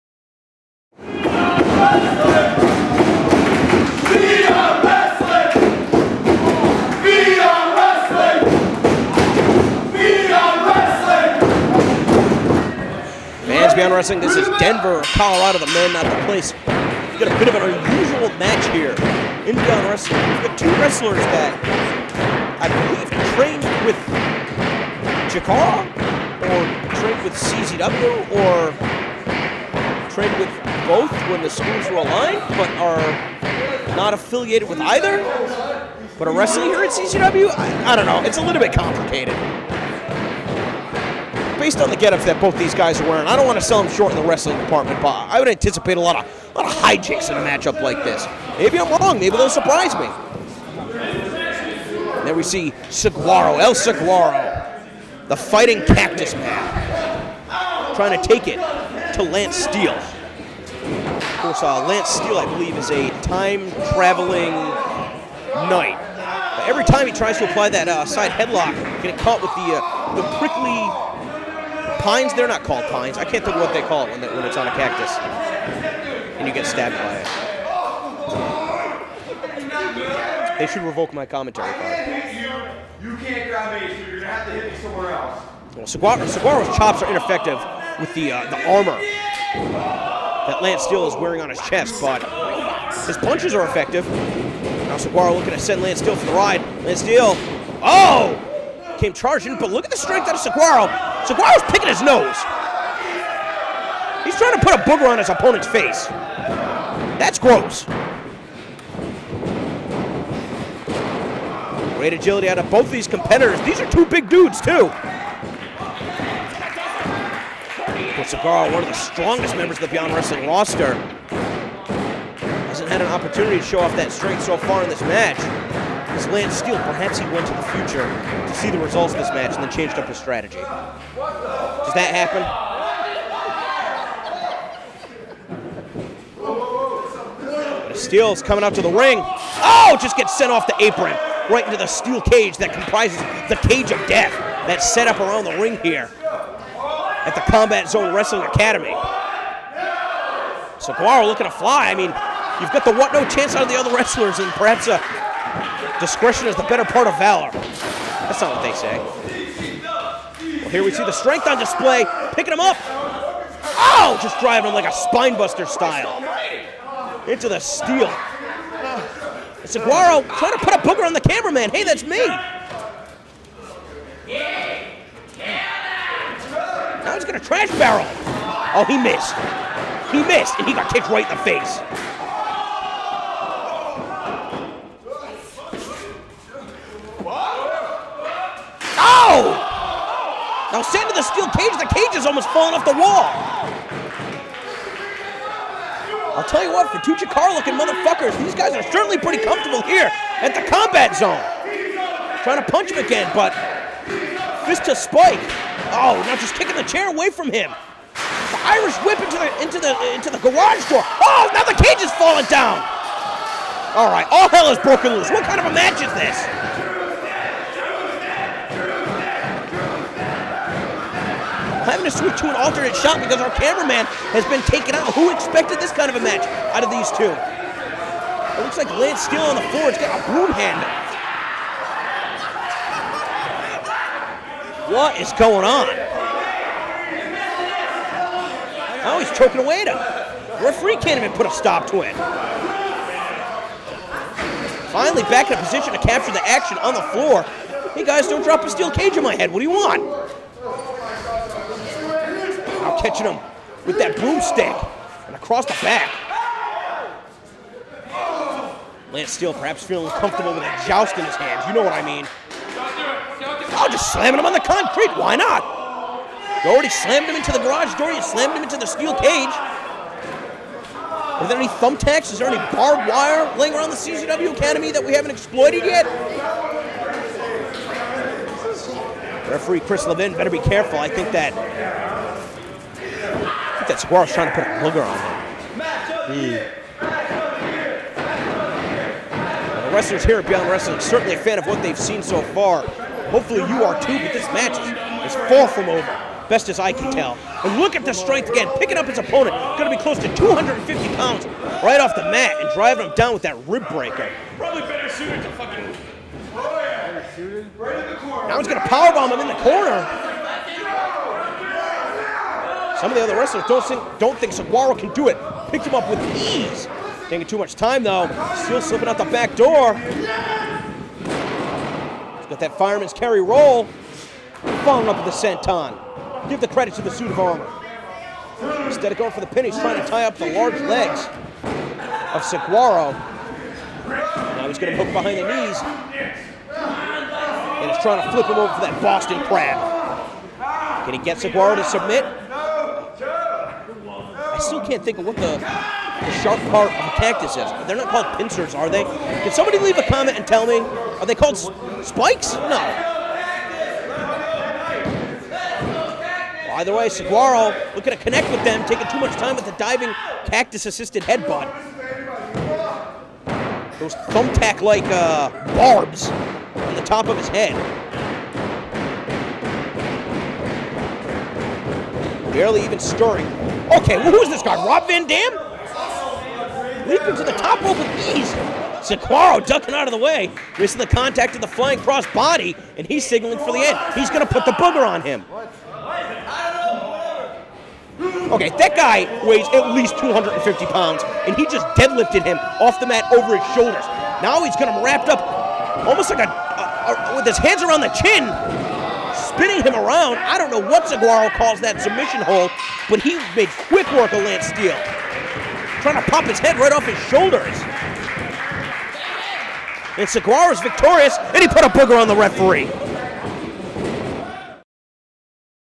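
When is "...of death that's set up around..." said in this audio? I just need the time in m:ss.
2:23.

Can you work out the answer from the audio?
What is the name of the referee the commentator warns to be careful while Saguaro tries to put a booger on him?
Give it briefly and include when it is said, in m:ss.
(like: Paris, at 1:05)
Chris Levin, at 4:39.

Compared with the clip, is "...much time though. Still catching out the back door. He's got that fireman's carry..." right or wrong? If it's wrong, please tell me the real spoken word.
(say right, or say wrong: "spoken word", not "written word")
wrong: "slipping", not "catching".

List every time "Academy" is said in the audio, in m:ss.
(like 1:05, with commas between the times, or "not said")
2:28, 4:34.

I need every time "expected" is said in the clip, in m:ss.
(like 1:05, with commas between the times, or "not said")
3:45.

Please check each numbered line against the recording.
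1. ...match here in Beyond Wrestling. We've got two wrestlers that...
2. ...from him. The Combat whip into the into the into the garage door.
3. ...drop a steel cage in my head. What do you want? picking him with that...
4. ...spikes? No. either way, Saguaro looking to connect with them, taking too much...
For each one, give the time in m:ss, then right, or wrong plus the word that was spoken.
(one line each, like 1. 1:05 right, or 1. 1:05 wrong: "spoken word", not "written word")
1. 0:18 right
2. 3:27 wrong: "Irish", not "Combat"
3. 4:08 wrong: "catching", not "picking"
4. 5:52 right.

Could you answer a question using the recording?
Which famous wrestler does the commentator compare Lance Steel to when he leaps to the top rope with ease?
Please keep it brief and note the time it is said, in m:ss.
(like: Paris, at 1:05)
Rob Van Dam, at 6:14.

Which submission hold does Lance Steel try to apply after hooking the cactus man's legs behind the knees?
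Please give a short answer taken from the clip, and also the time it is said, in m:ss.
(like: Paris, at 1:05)
Boston crab, at 5:39.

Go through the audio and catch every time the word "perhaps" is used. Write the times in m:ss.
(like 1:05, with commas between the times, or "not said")
2:06, 2:34, 4:19.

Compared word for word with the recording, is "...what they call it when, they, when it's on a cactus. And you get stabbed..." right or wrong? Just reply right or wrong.
right.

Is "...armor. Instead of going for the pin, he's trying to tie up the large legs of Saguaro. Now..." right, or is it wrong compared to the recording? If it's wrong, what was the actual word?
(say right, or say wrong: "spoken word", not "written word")
right.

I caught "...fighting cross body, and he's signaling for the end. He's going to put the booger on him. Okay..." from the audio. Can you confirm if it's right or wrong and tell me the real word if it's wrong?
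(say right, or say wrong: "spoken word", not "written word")
wrong: "flying", not "fighting".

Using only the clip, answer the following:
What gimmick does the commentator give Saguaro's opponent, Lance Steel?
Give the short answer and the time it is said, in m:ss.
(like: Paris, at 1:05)
time traveling knight, at 1:03.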